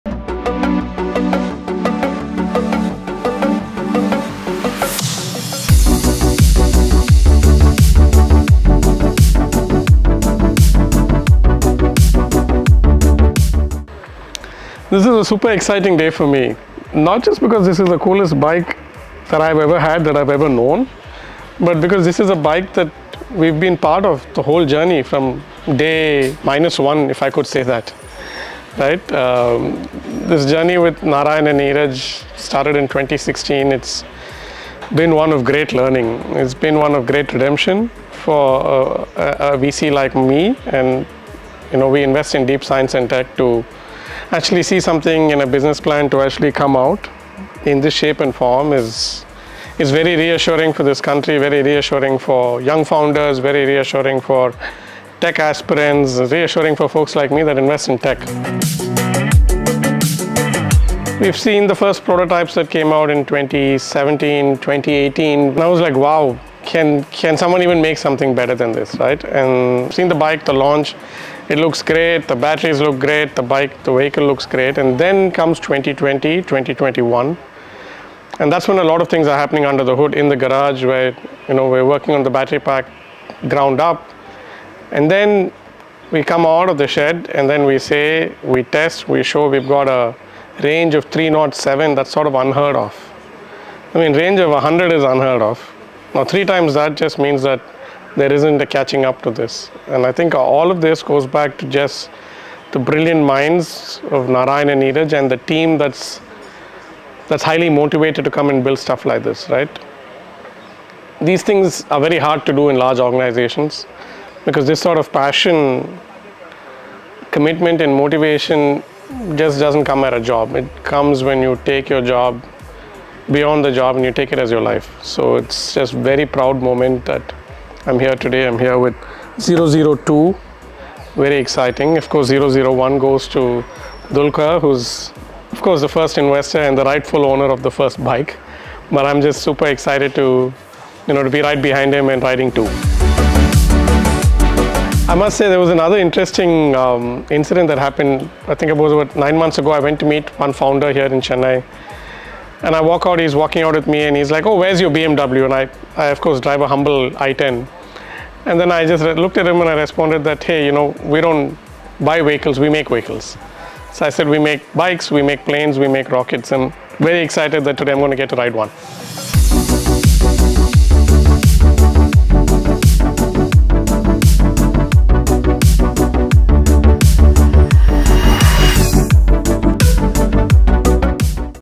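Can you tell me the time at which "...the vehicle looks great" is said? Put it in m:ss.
1:13.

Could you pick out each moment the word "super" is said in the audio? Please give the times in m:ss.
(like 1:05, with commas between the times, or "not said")
0:15, 2:19.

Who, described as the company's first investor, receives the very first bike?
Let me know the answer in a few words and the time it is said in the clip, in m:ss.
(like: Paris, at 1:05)
Dulquer, at 2:14.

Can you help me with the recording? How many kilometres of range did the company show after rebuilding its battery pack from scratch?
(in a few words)
307.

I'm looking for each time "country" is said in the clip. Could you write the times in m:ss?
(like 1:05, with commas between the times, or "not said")
0:51.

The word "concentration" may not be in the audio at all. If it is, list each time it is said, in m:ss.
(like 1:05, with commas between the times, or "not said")
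not said.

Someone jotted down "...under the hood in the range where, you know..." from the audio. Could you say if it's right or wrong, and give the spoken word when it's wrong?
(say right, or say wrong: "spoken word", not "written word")
wrong: "garage", not "range".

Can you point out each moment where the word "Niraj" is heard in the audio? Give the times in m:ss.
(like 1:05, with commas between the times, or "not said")
0:31, 1:44.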